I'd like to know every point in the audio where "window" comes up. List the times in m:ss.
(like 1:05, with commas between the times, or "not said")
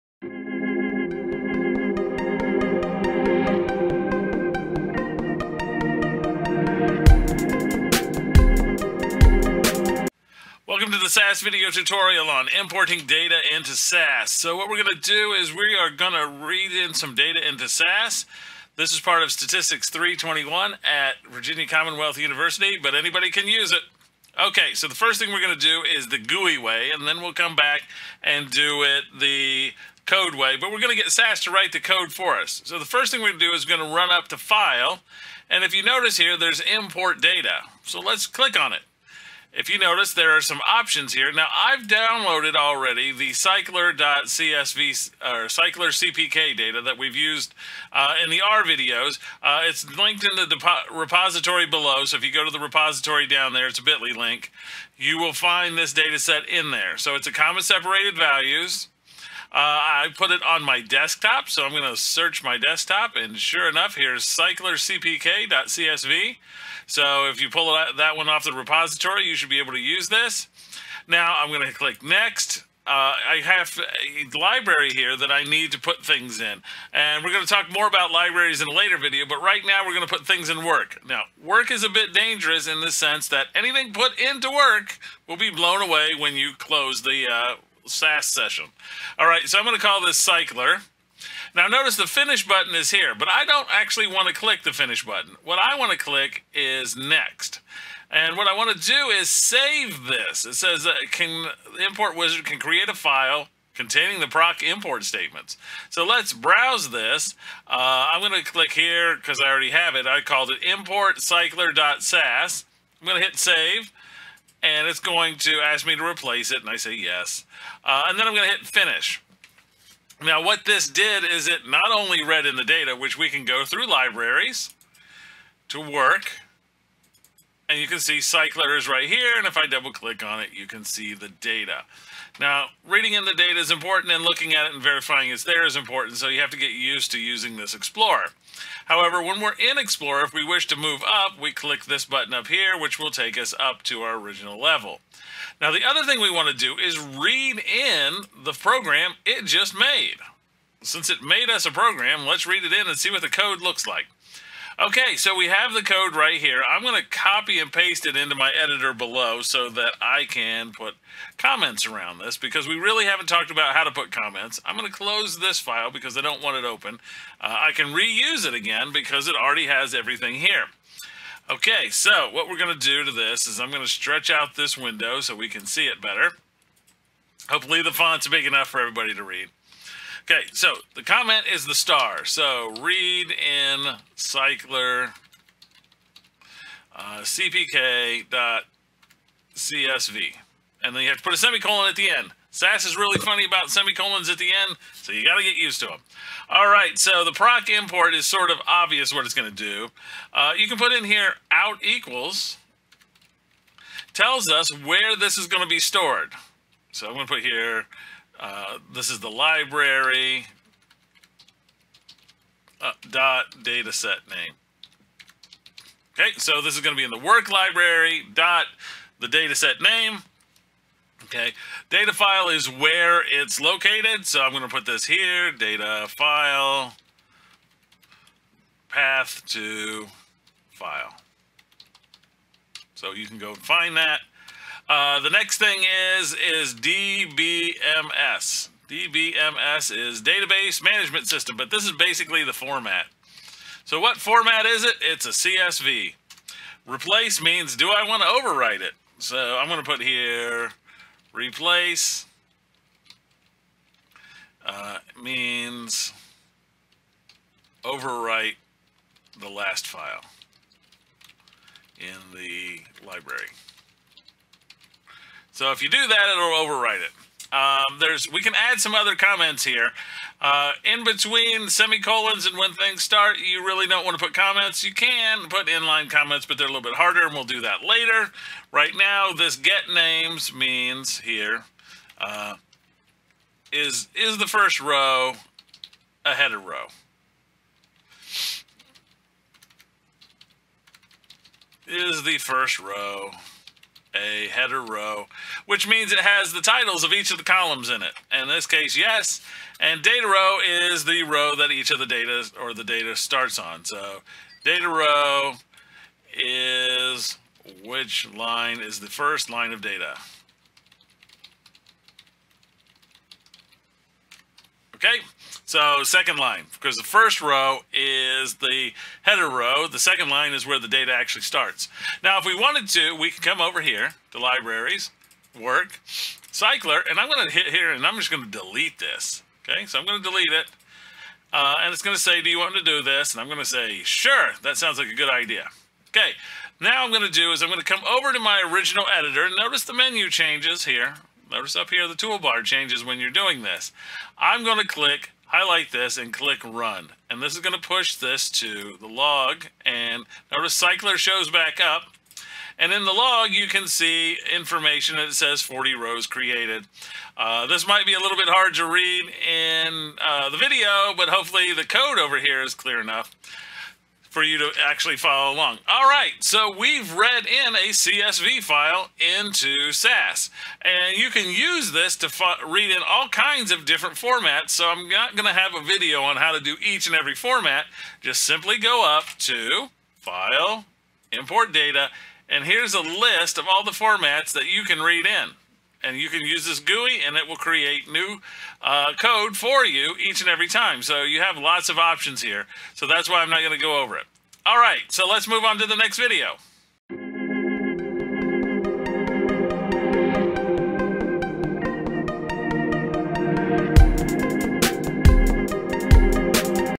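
2:54.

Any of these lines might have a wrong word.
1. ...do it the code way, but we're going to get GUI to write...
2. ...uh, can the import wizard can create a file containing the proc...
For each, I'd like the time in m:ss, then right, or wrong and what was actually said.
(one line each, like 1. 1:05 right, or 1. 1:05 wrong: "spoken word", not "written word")
1. 0:28 wrong: "SAS", not "GUI"
2. 1:40 right.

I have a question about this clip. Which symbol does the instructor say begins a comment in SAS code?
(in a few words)
star.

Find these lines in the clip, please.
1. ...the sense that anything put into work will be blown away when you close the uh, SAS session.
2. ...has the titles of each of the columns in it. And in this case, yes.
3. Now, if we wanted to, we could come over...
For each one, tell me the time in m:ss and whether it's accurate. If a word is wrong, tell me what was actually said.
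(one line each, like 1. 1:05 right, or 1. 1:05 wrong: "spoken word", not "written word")
1. 1:22 right
2. 4:56 right
3. 5:22 right.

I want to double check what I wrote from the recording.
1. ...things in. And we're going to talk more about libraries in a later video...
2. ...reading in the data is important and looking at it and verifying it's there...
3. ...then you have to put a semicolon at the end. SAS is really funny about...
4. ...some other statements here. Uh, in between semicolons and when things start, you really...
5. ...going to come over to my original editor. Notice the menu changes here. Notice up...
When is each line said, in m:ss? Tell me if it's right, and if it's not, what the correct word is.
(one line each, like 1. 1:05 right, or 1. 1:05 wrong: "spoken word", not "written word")
1. 1:16 right
2. 2:12 right
3. 3:10 right
4. 4:28 wrong: "comments", not "statements"
5. 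5:37 right.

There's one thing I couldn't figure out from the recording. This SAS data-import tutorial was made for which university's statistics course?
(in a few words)
Virginia Commonwealth University.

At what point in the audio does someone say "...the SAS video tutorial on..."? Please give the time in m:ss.
0:11.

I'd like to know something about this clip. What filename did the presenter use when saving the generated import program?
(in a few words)
import cycler.sas.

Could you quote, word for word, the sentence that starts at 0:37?
So let's click on it if you notice, there are some options here.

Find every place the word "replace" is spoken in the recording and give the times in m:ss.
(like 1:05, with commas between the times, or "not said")
1:56, 4:06, 4:11.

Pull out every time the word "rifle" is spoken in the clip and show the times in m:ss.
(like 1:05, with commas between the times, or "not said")
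not said.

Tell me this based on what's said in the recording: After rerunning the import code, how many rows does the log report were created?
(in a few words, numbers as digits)
40.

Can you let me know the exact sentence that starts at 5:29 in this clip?
Okay, so I'm going to delete it.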